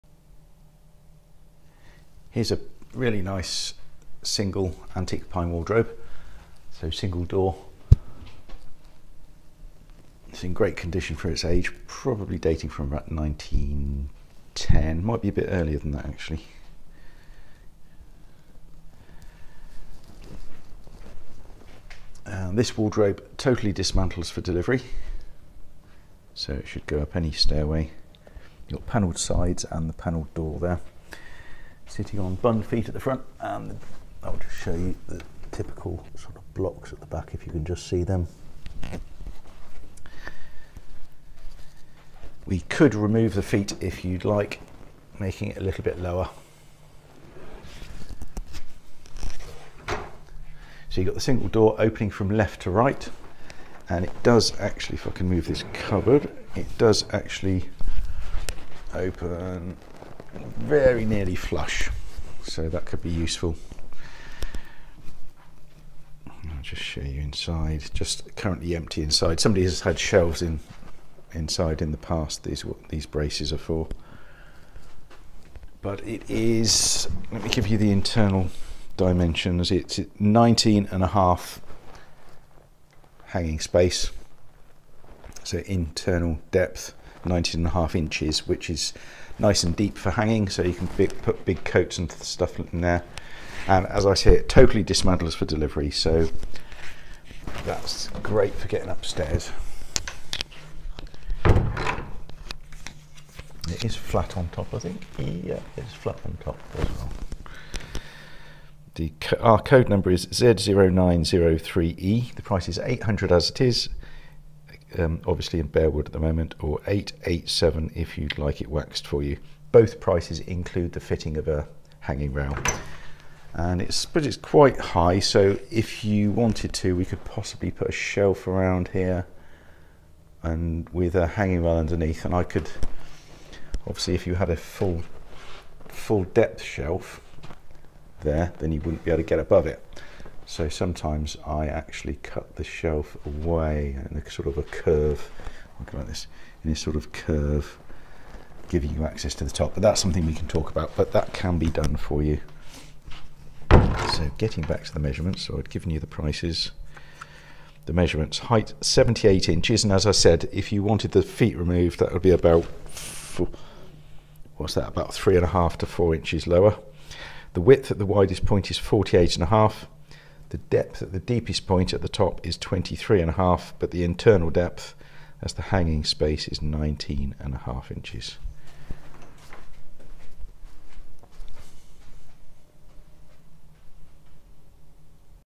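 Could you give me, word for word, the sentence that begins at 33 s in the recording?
And I'll just show you the typical sort of blocks at the back if you can just see them.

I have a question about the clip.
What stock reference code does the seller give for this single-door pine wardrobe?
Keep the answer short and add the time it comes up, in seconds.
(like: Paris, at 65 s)
Z0903E, at 110 s.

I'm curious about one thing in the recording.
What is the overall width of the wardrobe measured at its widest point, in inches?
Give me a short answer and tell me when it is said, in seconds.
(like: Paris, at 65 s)
48.5 inches, at 168 s.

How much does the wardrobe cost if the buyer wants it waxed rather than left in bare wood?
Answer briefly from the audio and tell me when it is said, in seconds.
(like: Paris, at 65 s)
887, at 116 s.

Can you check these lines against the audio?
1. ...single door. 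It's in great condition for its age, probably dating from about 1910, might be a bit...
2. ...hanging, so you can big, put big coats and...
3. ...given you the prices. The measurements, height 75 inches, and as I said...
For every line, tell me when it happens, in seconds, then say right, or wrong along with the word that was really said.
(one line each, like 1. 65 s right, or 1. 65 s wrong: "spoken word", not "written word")
1. 6 s right
2. 90 s right
3. 155 s wrong: "78", not "75".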